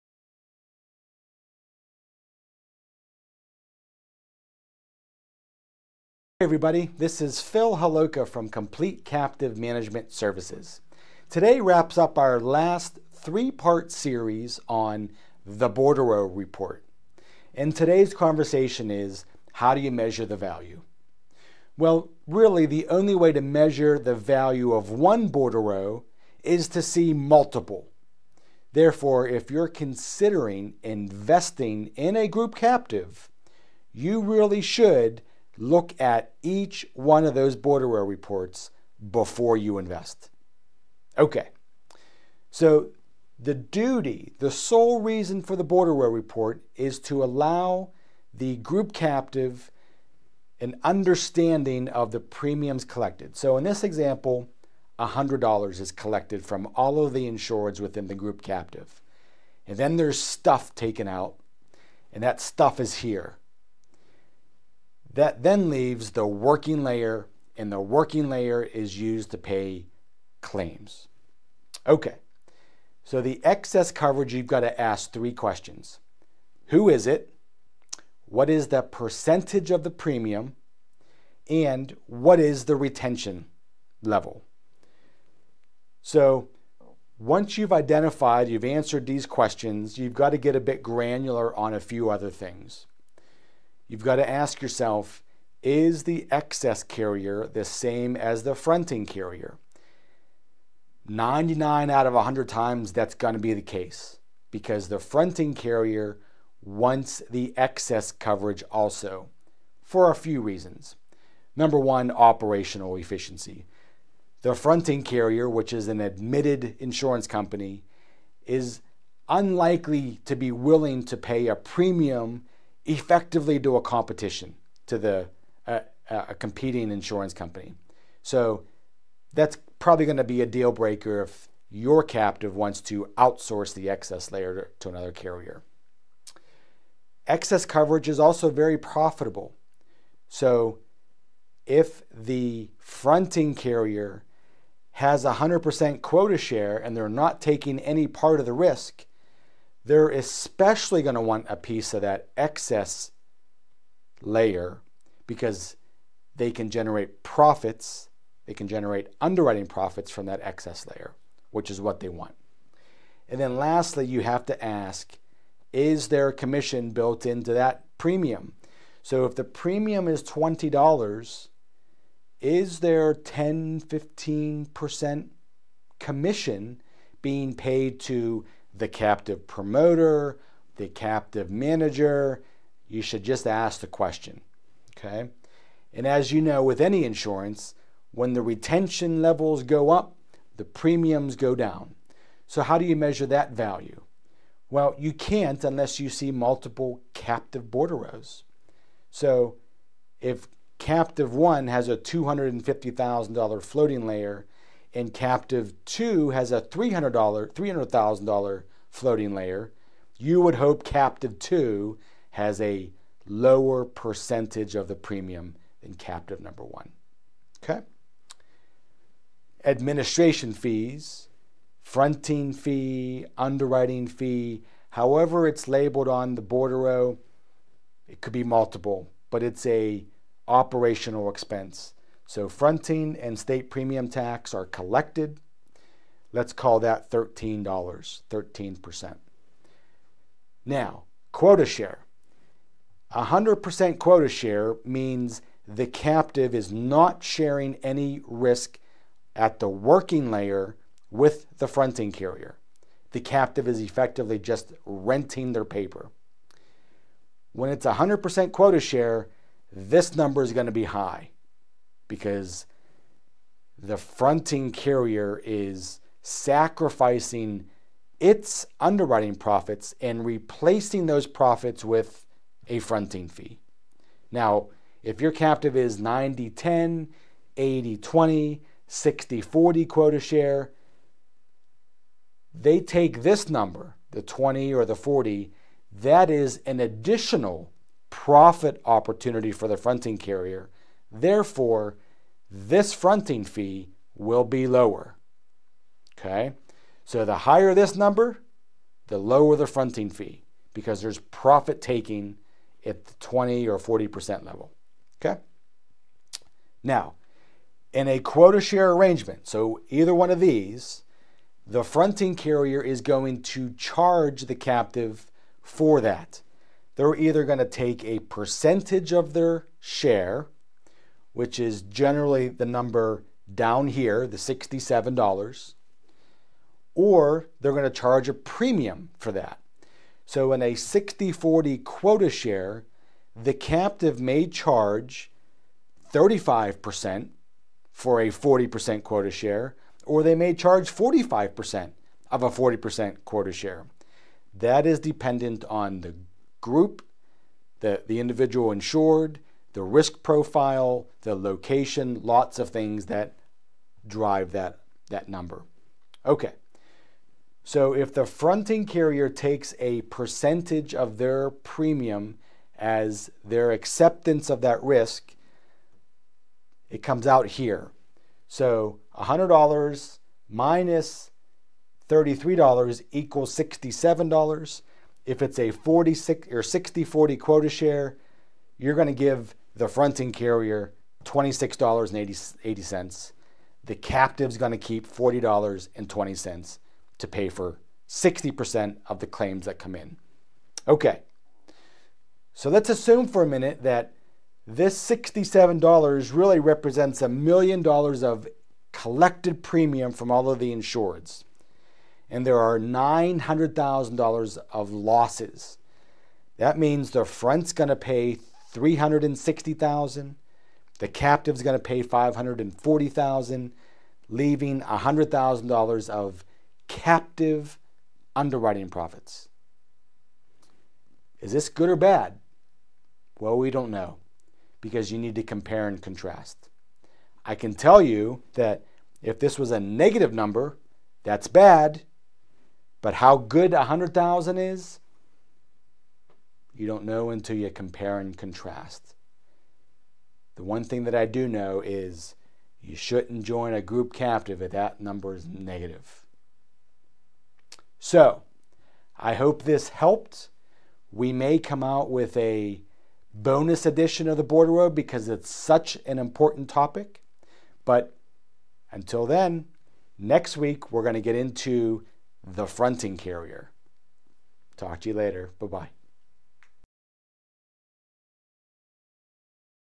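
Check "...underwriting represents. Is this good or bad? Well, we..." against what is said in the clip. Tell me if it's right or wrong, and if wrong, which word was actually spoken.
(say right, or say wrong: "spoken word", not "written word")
wrong: "profits", not "represents".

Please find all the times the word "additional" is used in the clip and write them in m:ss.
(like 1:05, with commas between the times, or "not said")
4:46.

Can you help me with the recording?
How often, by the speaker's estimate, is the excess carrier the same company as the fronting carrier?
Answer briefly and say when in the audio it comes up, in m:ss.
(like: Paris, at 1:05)
99 out of 100 times, at 1:41.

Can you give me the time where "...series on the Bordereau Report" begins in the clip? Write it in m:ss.
0:13.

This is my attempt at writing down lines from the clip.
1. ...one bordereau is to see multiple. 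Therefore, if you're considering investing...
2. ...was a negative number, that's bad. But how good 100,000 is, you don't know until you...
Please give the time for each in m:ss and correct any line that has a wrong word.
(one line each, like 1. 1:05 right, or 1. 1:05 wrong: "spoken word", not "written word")
1. 0:24 right
2. 7:09 right.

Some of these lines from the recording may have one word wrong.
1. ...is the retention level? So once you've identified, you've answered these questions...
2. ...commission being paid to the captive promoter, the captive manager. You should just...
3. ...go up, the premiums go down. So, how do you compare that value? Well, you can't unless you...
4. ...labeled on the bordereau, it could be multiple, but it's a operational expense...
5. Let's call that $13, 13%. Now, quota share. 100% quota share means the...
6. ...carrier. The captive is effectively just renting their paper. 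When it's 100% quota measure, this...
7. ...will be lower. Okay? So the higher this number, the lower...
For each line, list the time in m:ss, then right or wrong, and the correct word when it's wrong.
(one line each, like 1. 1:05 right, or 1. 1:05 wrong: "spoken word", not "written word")
1. 1:22 right
2. 2:55 right
3. 3:09 wrong: "measure", not "compare"
4. 3:45 right
5. 3:56 right
6. 4:12 wrong: "share", not "measure"
7. 4:54 right.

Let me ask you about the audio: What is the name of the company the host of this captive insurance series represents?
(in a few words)
Complete Captive Management Services.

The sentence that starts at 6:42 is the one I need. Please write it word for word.
And there are $900,000 of losses.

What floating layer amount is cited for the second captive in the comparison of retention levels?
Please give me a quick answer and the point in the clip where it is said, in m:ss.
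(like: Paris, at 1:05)
$300,000, at 3:27.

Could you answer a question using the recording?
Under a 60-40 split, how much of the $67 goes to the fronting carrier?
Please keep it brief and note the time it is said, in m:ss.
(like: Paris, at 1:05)
$26.80, at 6:21.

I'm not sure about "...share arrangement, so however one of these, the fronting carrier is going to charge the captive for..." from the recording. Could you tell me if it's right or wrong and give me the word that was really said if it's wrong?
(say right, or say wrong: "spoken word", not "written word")
wrong: "either", not "however".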